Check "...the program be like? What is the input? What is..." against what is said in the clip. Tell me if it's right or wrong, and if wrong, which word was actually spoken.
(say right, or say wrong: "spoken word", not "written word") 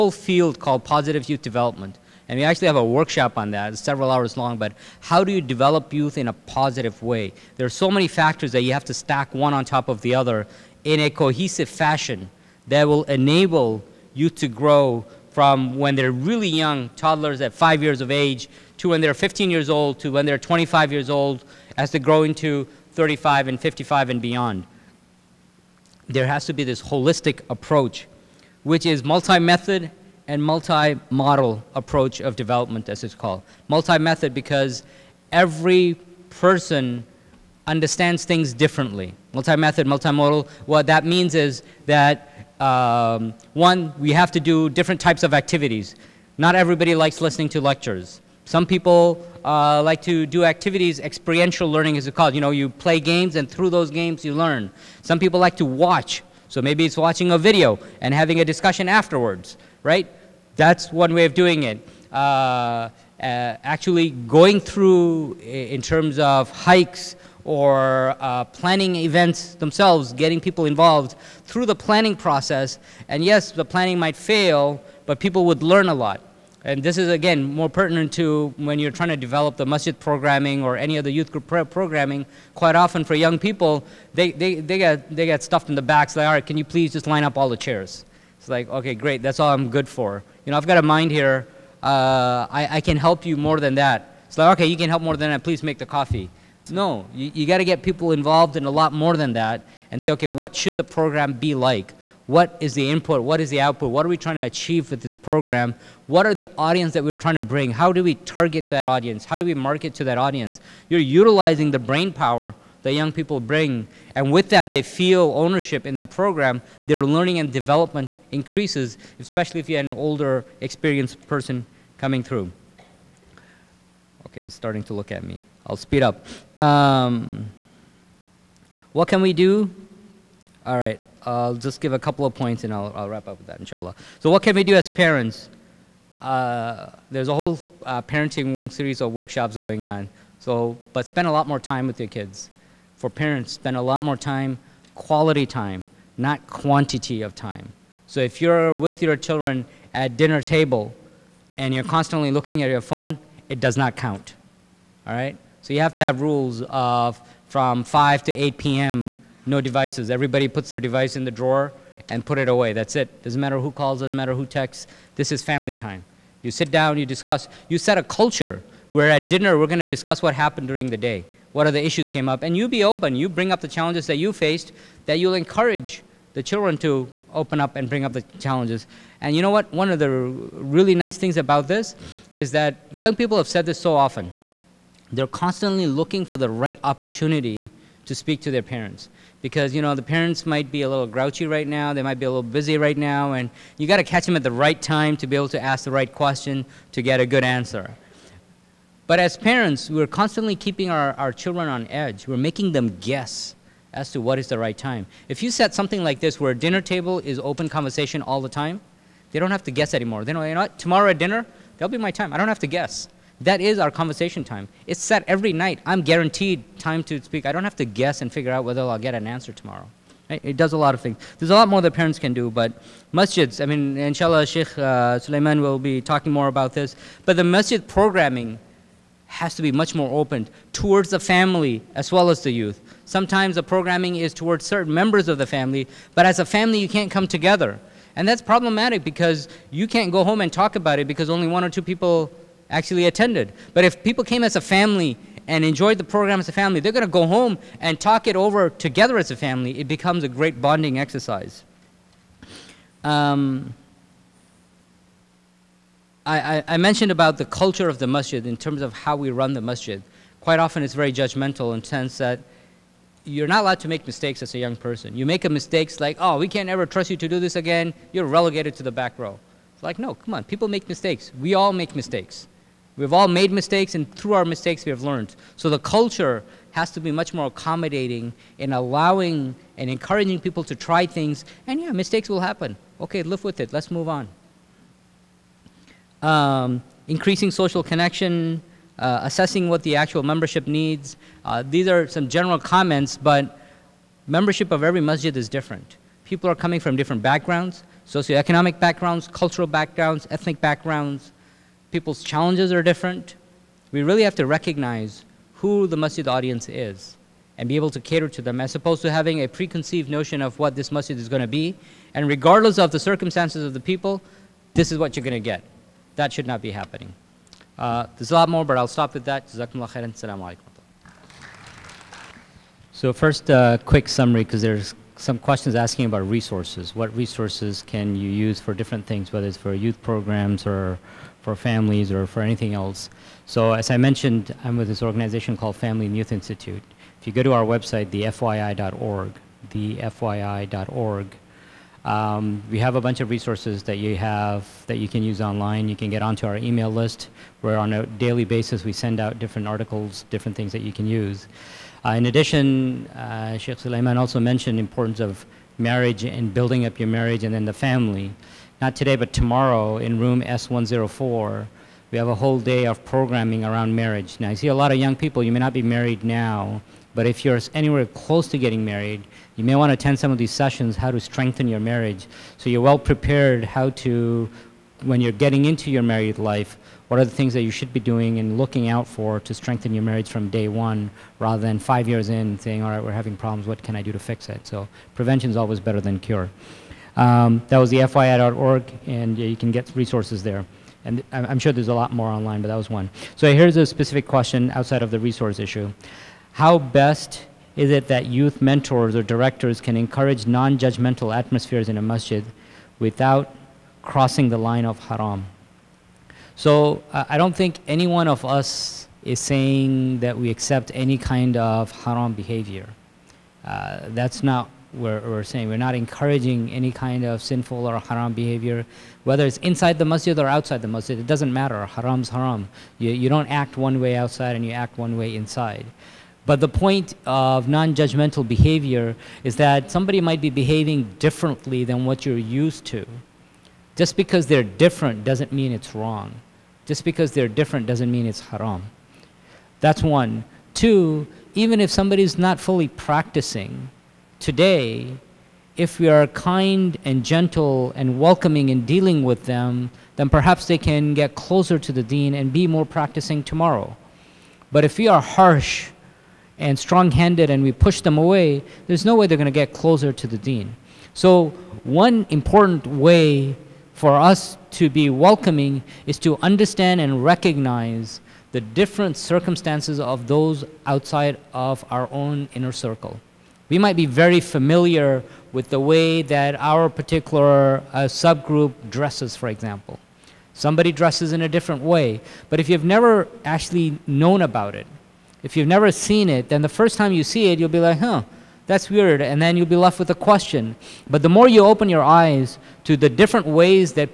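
right.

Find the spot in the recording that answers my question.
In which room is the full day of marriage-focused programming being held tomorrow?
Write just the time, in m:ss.
6:00.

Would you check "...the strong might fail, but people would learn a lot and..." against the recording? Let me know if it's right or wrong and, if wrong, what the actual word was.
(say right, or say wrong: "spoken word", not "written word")
wrong: "planning", not "strong".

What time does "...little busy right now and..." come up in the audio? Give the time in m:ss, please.
3:12.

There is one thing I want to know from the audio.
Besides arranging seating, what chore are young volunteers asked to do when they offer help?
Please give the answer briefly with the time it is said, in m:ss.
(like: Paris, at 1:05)
make the coffee, at 1:35.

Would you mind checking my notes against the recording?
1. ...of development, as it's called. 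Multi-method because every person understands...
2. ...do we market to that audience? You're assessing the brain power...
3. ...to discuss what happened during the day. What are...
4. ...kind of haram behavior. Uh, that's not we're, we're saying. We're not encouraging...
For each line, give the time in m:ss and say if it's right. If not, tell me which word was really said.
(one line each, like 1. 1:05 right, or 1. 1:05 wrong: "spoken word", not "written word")
1. 0:32 right
2. 1:49 wrong: "utilizing", not "assessing"
3. 2:49 right
4. 6:51 right.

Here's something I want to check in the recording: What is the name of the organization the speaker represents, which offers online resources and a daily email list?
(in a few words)
Family and Youth Institute.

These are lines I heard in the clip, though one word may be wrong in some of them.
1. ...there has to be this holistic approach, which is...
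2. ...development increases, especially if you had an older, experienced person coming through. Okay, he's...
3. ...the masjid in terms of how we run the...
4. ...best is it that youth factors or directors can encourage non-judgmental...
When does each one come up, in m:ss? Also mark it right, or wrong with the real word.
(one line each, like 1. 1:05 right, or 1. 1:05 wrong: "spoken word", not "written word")
1. 0:26 right
2. 1:57 right
3. 4:17 right
4. 6:36 wrong: "mentors", not "factors".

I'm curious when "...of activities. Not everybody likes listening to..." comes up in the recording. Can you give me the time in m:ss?
0:45.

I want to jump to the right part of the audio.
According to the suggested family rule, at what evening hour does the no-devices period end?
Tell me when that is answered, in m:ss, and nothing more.
2:38.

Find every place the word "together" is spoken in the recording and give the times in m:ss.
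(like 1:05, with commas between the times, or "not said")
3:57, 4:08.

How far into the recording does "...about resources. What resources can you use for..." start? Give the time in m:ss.
5:26.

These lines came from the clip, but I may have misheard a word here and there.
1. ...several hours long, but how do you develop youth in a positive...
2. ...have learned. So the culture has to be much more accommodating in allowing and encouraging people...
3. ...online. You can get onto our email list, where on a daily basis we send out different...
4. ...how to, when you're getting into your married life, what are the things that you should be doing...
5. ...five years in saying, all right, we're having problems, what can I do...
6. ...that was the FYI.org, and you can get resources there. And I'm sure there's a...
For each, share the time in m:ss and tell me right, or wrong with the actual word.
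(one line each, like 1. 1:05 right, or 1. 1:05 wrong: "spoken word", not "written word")
1. 0:03 right
2. 4:34 right
3. 5:45 right
4. 6:13 right
5. 6:21 right
6. 6:27 right.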